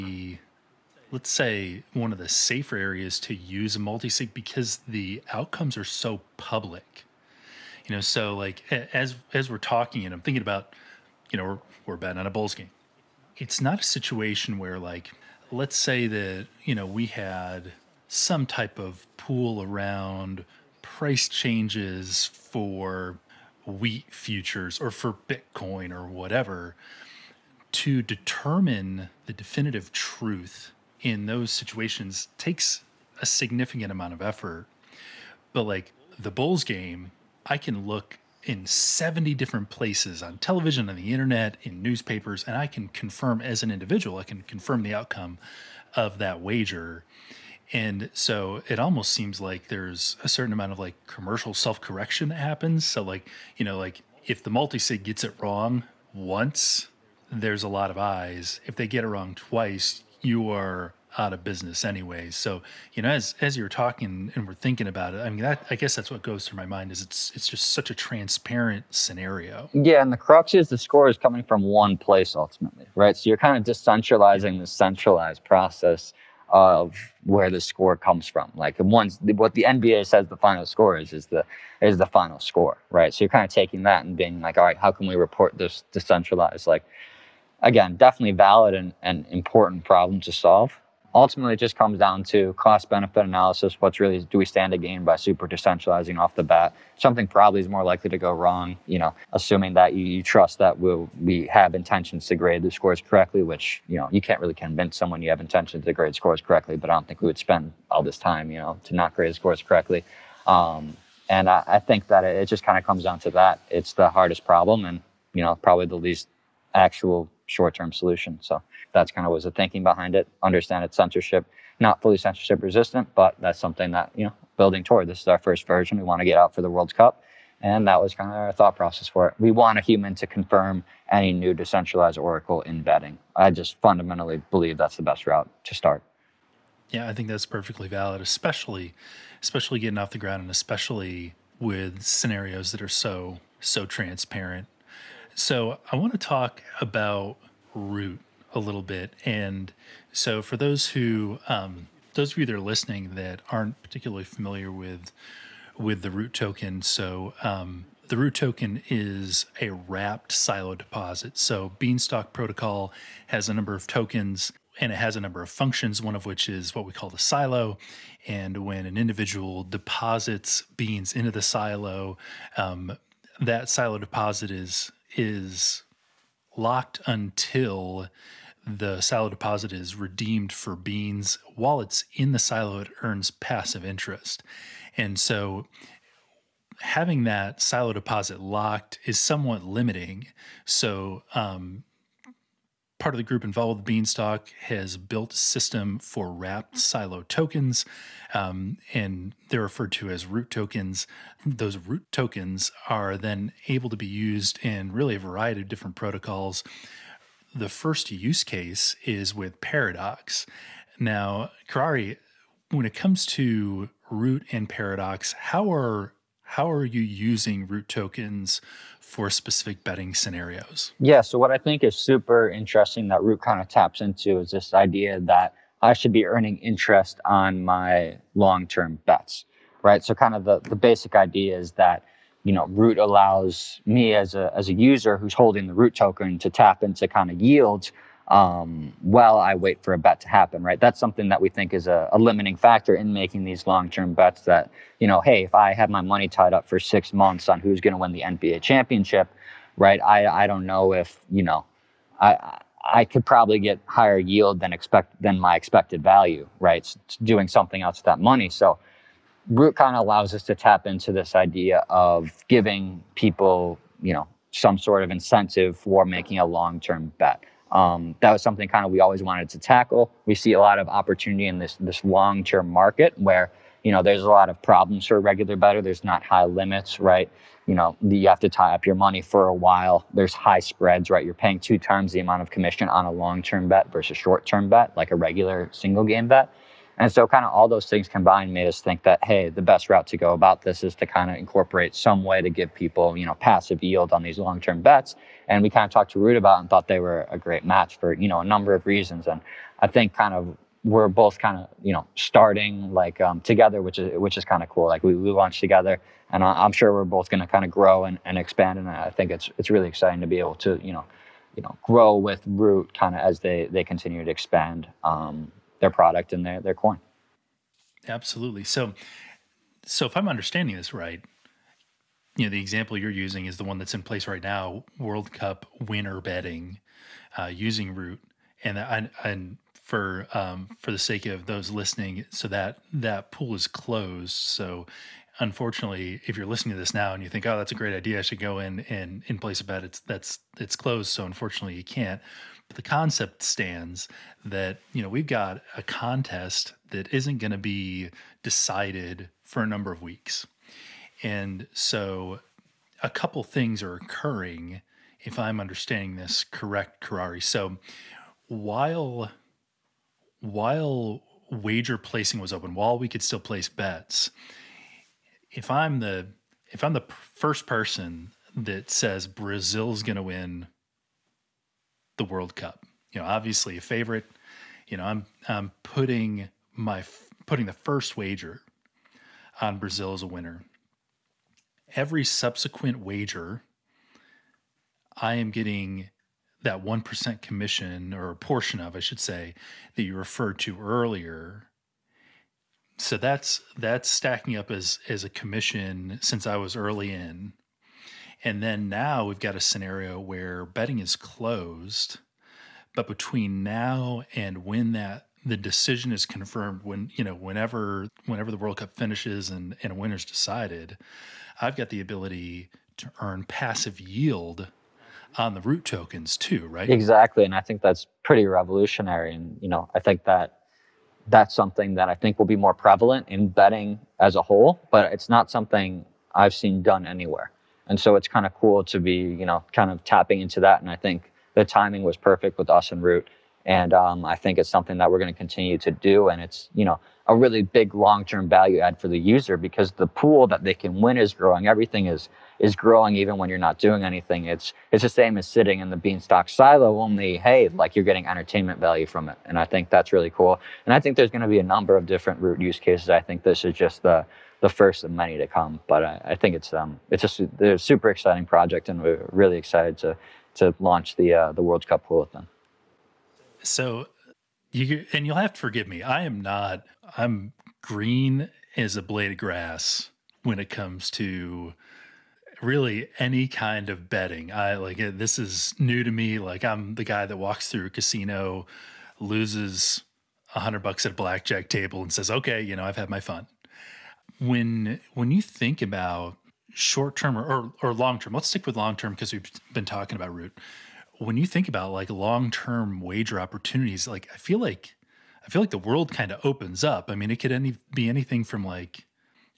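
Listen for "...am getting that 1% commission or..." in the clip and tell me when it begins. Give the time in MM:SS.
06:25.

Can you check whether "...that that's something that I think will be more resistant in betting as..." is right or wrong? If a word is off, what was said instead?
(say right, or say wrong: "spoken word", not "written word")
wrong: "prevalent", not "resistant".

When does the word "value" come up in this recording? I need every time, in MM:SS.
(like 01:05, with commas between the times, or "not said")
04:16, 07:18, 07:28.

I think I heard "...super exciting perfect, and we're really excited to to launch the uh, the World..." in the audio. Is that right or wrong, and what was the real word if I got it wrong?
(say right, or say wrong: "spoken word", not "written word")
wrong: "project", not "perfect".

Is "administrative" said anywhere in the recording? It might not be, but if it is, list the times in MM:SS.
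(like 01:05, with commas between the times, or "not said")
not said.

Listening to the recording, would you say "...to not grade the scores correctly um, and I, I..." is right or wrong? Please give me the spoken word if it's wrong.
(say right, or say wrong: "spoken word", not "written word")
right.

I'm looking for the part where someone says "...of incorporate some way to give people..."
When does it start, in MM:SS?
04:51.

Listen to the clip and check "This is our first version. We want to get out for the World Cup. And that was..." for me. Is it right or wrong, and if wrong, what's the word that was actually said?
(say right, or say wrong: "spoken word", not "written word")
right.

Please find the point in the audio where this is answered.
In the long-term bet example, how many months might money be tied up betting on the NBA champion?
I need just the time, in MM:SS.
04:06.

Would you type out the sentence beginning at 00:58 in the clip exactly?
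If they get it wrong twice, you are out of business anyway.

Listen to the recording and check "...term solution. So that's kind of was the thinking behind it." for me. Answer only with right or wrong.
right.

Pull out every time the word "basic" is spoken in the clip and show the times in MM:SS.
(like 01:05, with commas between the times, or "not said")
03:50.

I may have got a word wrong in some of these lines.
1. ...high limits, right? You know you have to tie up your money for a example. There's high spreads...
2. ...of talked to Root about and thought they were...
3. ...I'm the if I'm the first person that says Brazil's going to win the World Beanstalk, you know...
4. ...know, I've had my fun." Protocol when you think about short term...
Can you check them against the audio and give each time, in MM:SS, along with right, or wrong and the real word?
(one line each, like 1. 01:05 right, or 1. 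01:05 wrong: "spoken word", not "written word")
1. 04:36 wrong: "while", not "example"
2. 04:55 right
3. 06:05 wrong: "Cup", not "Beanstalk"
4. 08:02 wrong: "When", not "Protocol".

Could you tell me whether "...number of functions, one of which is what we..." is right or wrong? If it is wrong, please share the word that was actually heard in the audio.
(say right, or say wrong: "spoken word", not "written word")
right.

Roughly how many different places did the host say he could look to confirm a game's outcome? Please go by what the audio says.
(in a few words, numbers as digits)
70.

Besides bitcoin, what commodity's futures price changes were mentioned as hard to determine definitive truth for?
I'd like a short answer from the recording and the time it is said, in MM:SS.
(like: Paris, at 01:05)
wheat, at 00:23.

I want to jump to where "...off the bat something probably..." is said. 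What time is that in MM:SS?
01:36.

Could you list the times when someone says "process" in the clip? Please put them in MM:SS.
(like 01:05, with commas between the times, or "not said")
01:15, 02:08.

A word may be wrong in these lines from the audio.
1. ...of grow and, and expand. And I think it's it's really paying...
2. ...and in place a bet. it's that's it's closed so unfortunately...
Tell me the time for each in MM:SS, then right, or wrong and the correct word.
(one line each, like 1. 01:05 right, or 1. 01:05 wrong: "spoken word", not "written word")
1. 05:07 wrong: "exciting", not "paying"
2. 05:38 right.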